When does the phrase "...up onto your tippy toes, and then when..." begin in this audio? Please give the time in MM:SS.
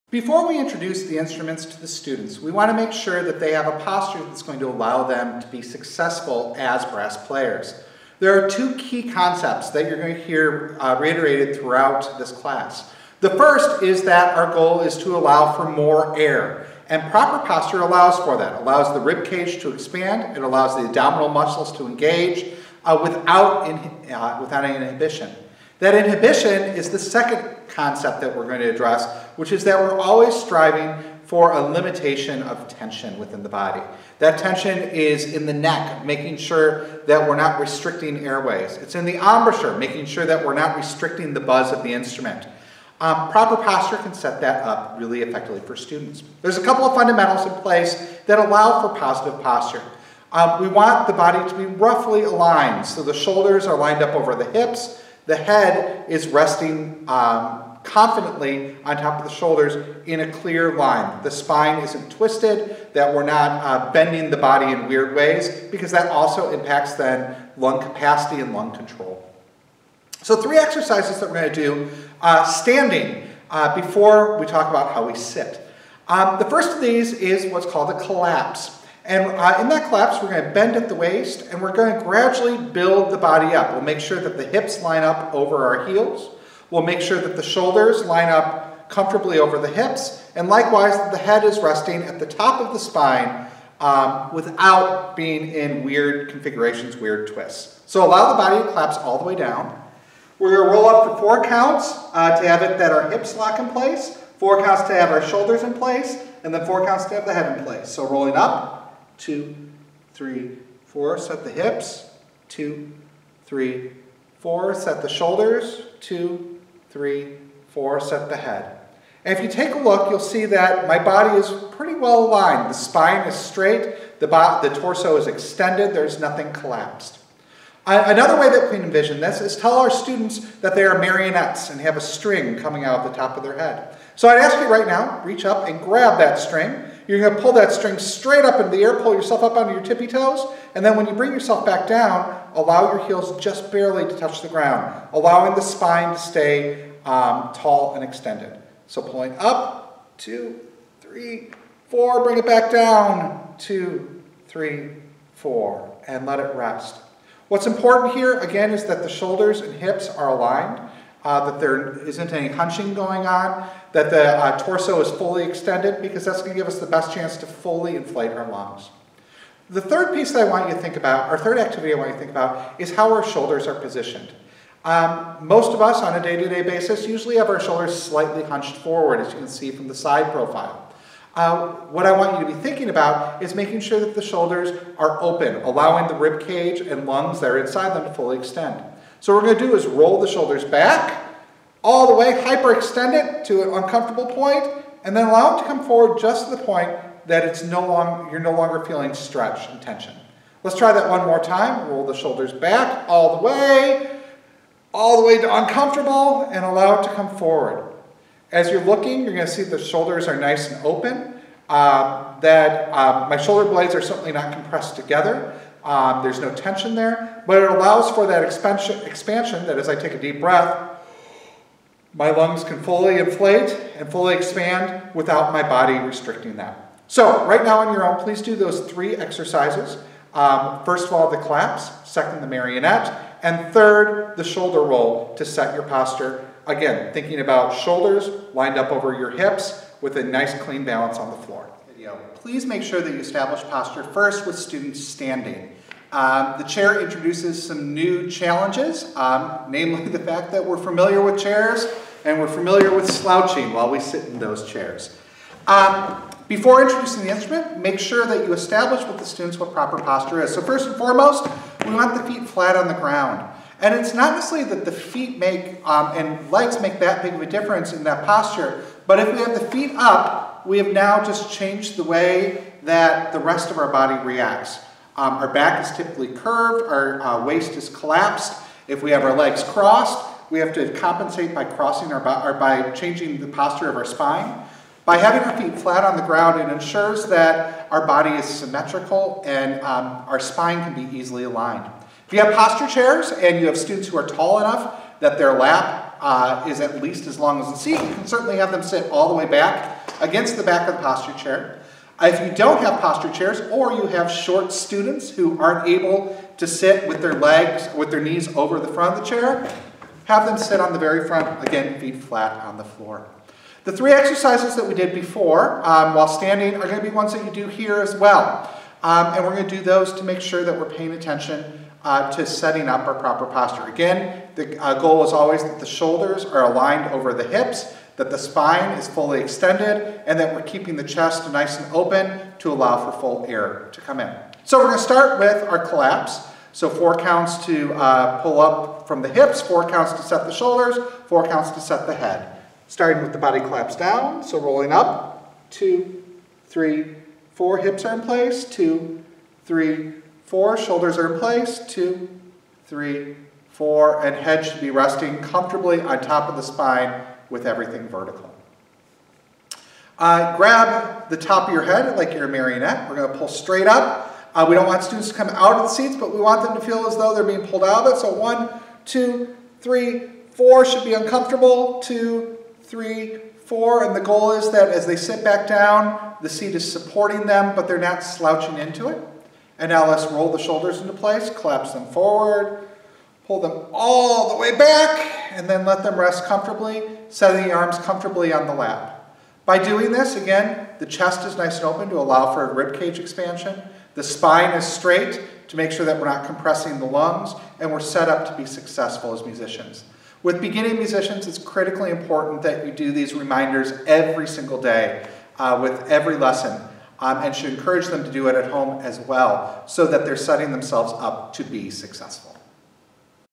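02:19.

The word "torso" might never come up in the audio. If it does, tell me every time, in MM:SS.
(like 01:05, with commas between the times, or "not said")
02:04, 02:44.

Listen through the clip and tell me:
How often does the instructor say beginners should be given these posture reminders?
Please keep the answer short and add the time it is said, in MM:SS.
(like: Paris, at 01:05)
every single day, at 06:44.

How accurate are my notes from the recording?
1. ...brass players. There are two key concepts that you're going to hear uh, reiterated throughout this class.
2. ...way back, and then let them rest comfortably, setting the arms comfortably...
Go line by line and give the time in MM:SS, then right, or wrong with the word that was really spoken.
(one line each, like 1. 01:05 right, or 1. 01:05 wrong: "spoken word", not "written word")
1. 00:06 right
2. 06:24 right.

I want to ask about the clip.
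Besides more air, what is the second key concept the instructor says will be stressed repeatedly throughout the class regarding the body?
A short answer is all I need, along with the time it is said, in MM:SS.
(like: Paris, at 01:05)
limitation of tension, at 00:31.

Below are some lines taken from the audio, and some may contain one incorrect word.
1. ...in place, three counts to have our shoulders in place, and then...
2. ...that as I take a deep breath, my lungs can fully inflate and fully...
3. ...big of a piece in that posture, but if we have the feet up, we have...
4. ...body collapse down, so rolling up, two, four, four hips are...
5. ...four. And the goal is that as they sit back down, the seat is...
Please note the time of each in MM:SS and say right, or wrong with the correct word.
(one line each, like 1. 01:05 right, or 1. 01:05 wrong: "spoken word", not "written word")
1. 01:43 wrong: "four", not "three"
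2. 03:39 right
3. 04:27 wrong: "difference", not "piece"
4. 05:43 wrong: "three", not "four"
5. 06:13 right.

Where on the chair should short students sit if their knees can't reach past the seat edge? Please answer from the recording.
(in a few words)
on the very front.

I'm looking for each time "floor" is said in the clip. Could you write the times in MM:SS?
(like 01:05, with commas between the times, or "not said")
04:01, 05:12.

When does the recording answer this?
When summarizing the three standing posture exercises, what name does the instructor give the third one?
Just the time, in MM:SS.
03:54.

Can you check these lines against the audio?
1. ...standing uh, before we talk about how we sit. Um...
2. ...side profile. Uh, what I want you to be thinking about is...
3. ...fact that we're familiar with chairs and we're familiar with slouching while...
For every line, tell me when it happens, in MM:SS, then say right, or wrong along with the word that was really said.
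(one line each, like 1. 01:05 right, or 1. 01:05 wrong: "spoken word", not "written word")
1. 01:12 right
2. 02:59 right
3. 04:10 right.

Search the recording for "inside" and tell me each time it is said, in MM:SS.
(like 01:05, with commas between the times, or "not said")
03:07.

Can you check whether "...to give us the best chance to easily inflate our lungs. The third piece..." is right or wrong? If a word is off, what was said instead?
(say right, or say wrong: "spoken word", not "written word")
wrong: "fully", not "easily".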